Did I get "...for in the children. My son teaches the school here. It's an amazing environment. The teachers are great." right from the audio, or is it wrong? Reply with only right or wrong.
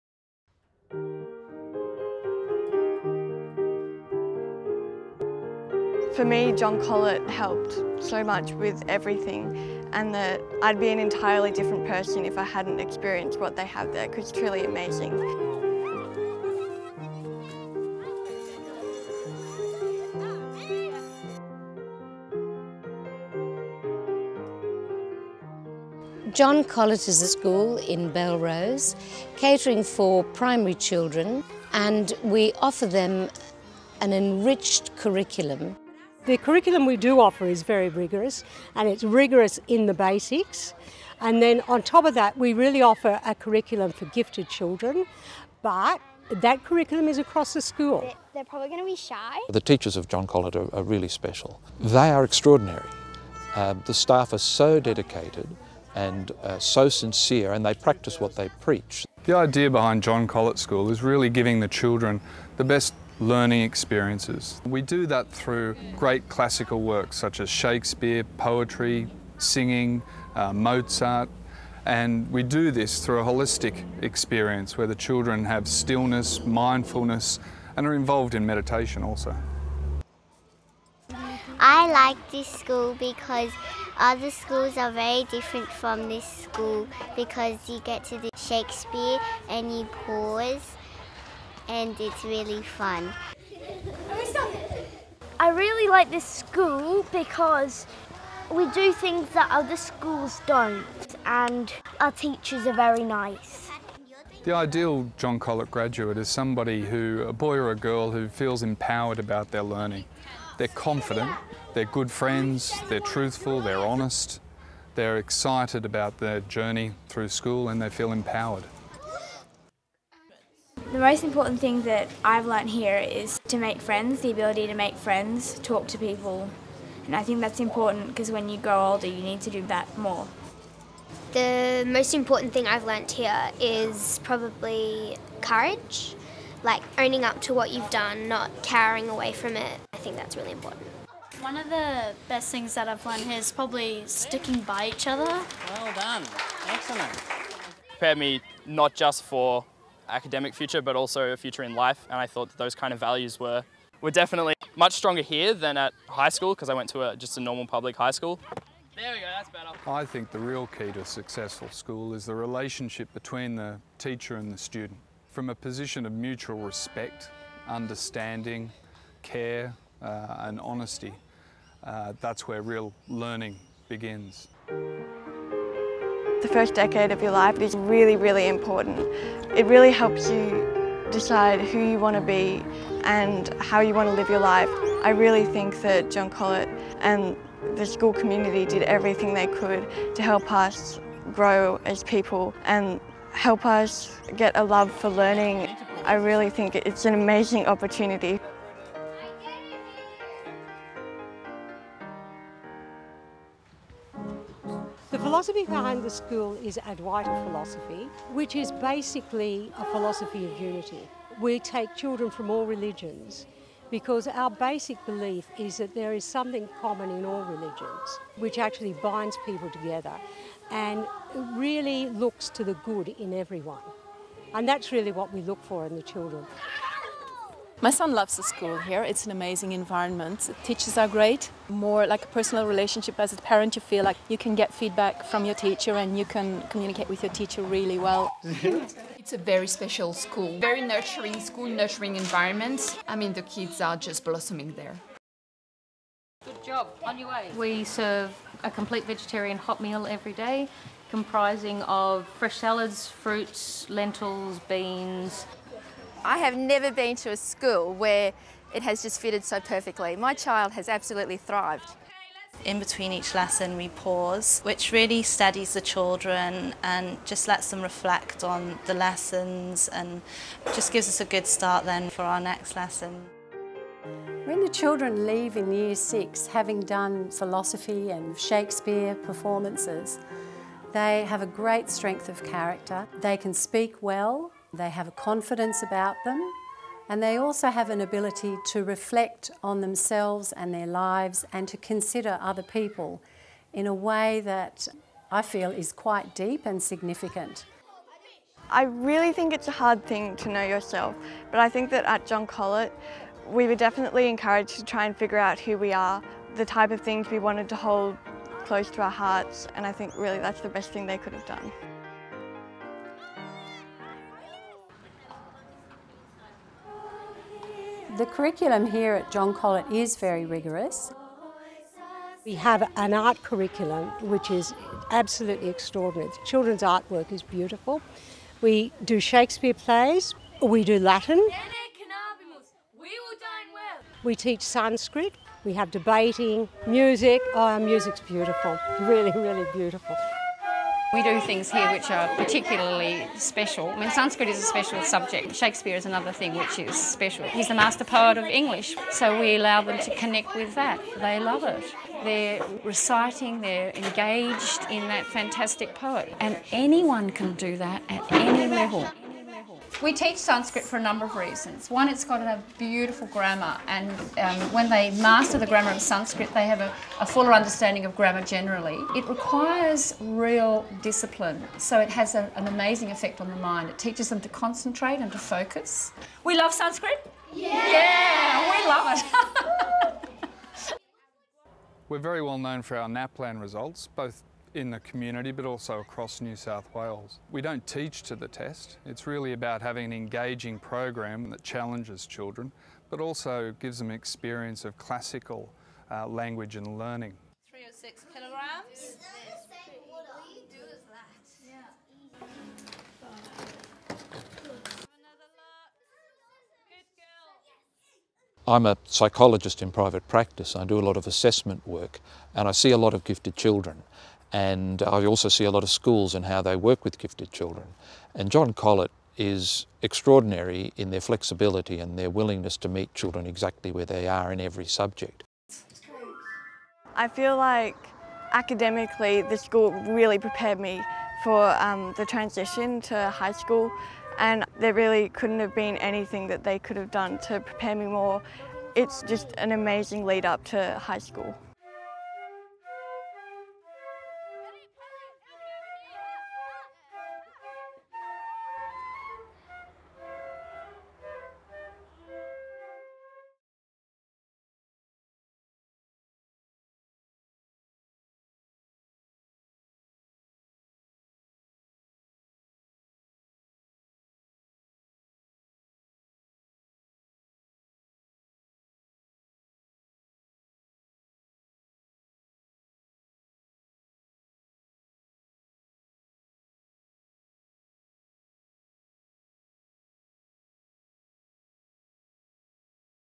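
wrong.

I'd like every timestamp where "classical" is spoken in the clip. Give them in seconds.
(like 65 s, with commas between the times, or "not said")
66 s, 394 s.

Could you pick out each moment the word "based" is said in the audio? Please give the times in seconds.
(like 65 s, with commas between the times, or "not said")
not said.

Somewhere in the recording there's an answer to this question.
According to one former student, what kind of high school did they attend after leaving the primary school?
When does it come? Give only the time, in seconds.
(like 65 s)
157 s.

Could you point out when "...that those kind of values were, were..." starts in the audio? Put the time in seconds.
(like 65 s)
152 s.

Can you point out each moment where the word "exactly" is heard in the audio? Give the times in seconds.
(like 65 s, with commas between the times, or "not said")
423 s.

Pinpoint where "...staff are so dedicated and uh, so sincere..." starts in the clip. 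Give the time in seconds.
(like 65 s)
53 s.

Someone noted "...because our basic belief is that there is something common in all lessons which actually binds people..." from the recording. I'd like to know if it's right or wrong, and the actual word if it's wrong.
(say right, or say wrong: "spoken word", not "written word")
wrong: "religions", not "lessons".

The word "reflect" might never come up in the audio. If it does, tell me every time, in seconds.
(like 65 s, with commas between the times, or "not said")
267 s, 288 s.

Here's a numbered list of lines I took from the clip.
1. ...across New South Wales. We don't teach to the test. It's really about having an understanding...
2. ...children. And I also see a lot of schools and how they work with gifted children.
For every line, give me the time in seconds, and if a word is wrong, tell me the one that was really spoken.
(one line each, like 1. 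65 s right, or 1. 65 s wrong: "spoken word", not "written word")
1. 385 s wrong: "engaging", not "understanding"
2. 413 s right.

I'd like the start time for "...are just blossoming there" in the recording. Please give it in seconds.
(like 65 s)
243 s.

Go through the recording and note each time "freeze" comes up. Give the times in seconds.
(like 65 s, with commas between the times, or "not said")
not said.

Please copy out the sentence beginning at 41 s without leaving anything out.
And then on top of that, we really offer a curriculum for gifted children, but that curriculum is across the school.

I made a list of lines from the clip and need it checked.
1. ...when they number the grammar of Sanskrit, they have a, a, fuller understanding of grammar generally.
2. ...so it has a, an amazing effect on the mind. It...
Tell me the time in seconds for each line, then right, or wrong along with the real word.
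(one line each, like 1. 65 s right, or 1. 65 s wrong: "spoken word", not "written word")
1. 364 s wrong: "master", not "number"
2. 371 s right.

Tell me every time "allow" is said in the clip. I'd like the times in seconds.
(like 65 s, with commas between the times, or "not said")
349 s.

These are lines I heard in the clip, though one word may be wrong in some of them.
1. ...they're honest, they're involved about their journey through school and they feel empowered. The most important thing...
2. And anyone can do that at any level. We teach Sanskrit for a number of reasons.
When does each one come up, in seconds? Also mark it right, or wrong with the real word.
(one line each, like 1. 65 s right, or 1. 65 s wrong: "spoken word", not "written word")
1. 113 s wrong: "excited", not "involved"
2. 356 s right.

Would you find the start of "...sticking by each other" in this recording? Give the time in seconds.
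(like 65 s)
144 s.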